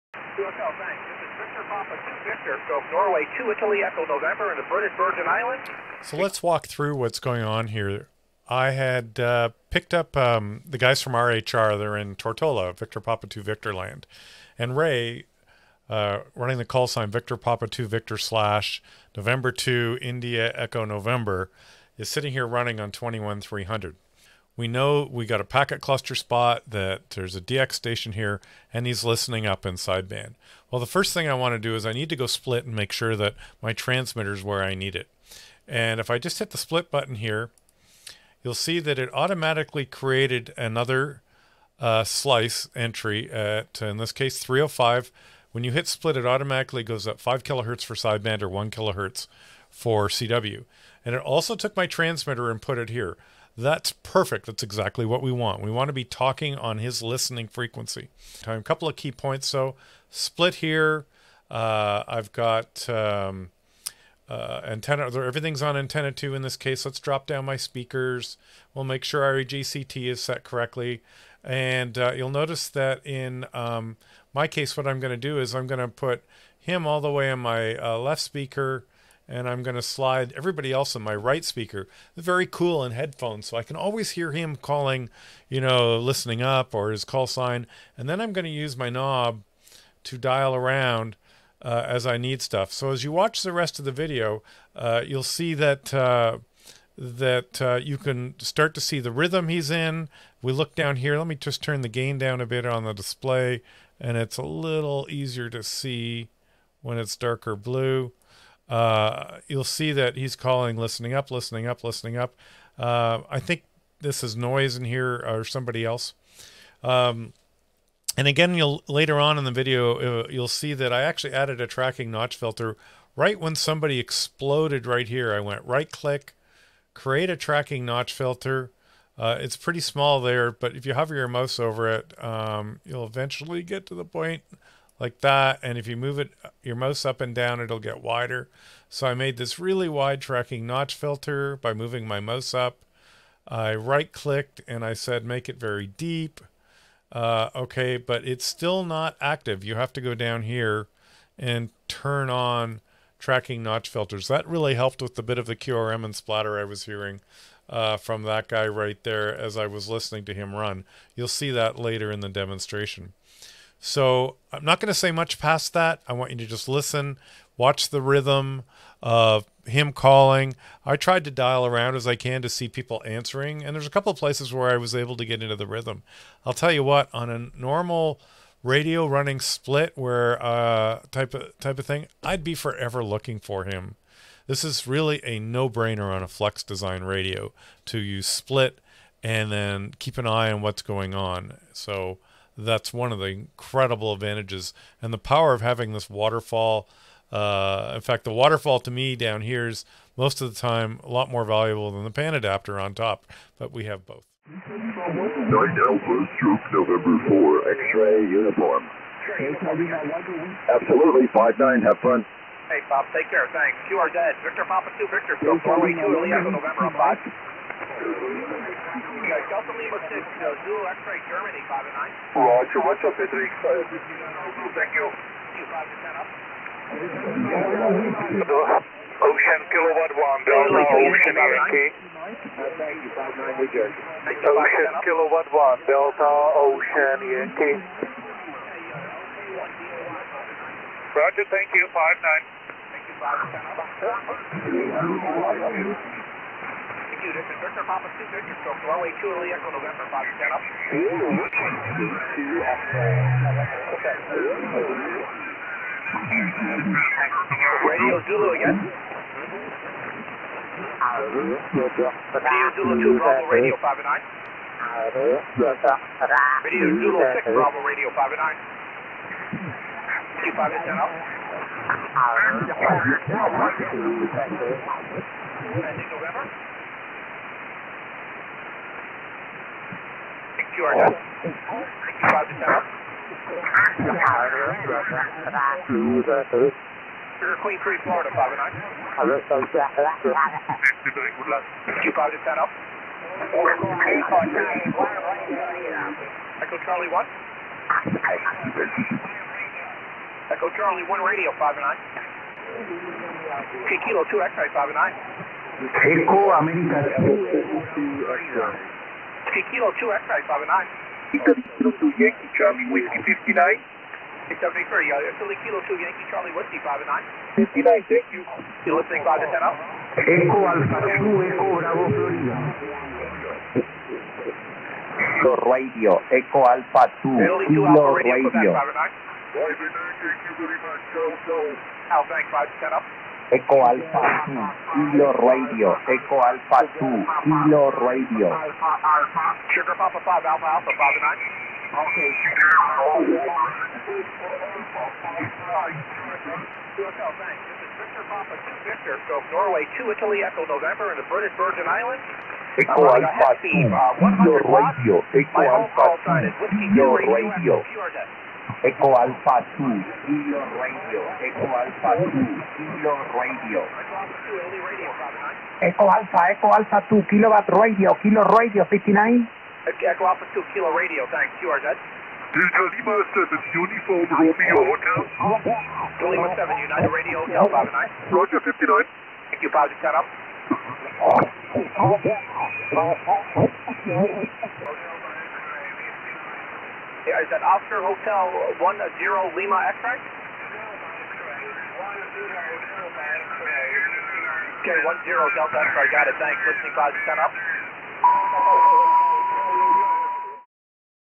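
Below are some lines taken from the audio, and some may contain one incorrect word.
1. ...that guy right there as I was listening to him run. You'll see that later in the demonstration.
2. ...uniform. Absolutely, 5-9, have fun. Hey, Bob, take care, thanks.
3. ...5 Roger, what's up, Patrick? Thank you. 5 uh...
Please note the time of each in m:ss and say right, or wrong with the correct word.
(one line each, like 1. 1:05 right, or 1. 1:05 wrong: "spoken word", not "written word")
1. 2:38 right
2. 3:28 right
3. 3:41 right.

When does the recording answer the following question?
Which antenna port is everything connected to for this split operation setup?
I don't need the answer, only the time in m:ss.
1:05.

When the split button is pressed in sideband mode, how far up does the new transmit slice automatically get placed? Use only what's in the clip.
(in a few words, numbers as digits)
5 kilohertz.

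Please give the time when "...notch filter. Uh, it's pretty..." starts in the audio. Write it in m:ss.
2:07.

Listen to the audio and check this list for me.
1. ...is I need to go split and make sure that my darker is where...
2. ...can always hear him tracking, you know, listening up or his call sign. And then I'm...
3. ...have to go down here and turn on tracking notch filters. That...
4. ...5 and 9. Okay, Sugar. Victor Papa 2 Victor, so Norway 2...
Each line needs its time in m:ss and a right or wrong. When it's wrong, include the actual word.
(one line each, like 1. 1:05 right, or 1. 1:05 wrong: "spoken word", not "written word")
1. 0:31 wrong: "transmitter", not "darker"
2. 1:23 wrong: "calling", not "tracking"
3. 2:29 right
4. 5:40 right.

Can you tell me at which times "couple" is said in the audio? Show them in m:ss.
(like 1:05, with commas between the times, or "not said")
0:58, 2:53.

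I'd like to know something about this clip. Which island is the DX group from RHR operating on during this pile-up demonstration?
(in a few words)
Tortola.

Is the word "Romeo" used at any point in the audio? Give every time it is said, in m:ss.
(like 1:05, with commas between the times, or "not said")
6:14.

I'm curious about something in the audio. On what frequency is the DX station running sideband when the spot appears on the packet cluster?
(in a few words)
21300.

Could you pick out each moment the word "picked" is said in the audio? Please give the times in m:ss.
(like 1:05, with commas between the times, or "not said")
0:09.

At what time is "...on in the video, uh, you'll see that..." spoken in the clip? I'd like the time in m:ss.
1:59.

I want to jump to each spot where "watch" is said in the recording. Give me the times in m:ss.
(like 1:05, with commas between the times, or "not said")
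1:33, 2:47.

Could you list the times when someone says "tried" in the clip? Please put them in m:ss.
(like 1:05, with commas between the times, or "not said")
2:50.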